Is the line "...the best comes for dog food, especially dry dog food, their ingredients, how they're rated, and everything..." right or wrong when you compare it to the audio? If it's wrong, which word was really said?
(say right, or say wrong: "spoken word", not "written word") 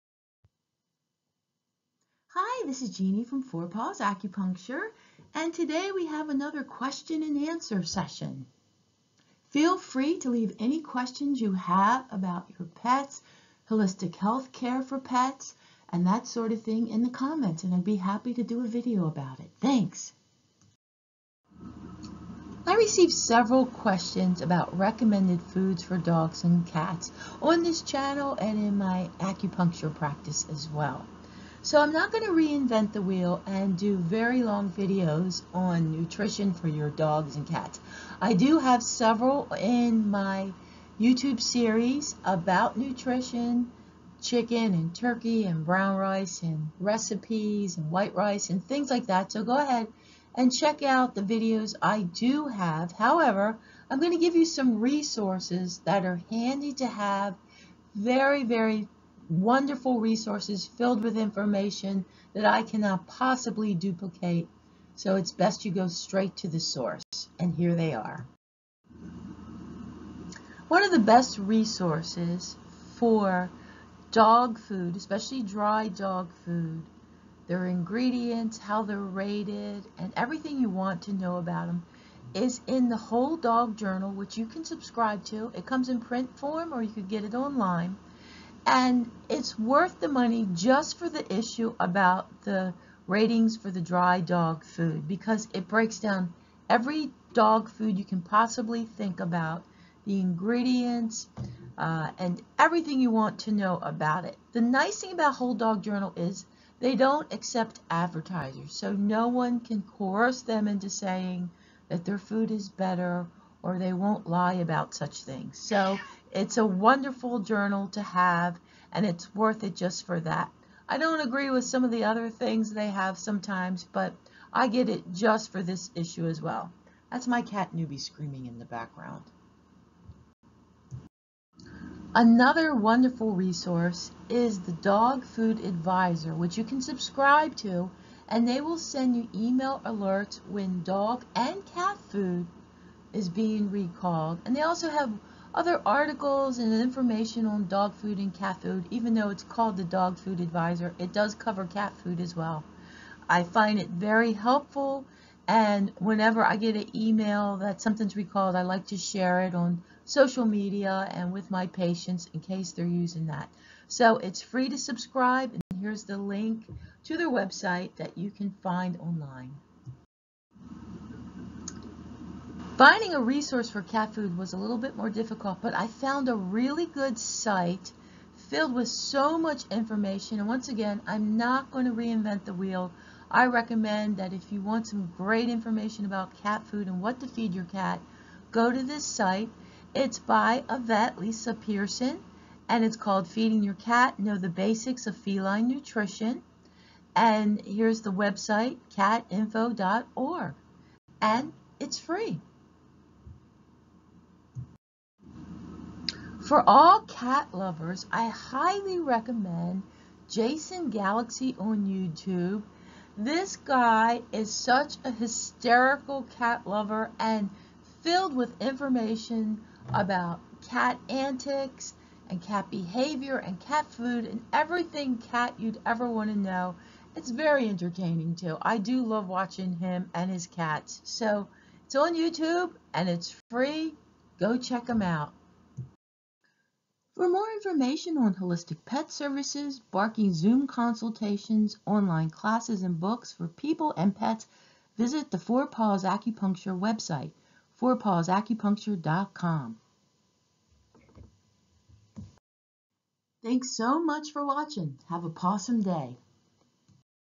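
wrong: "resources", not "comes".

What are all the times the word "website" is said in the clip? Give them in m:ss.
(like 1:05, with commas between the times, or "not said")
2:47, 3:18, 4:06.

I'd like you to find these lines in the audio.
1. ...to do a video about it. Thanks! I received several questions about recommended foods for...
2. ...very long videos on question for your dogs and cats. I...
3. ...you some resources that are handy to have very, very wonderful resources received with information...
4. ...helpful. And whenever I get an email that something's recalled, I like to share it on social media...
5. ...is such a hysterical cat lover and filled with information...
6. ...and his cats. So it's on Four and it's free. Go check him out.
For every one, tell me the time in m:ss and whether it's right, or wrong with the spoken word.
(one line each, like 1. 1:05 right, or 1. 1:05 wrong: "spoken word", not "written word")
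1. 0:18 right
2. 0:33 wrong: "nutrition", not "question"
3. 0:54 wrong: "filled", not "received"
4. 2:34 right
5. 3:34 right
6. 3:50 wrong: "YouTube", not "Four".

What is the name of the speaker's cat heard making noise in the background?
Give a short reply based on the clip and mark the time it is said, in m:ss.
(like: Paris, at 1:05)
Newbie, at 2:07.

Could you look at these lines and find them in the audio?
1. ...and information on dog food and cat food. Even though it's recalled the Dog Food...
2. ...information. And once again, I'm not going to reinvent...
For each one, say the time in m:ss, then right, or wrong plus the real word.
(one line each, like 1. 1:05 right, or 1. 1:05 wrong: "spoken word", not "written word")
1. 2:26 wrong: "called", not "recalled"
2. 2:59 right.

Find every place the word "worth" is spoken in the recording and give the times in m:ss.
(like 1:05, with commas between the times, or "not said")
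1:29, 1:59.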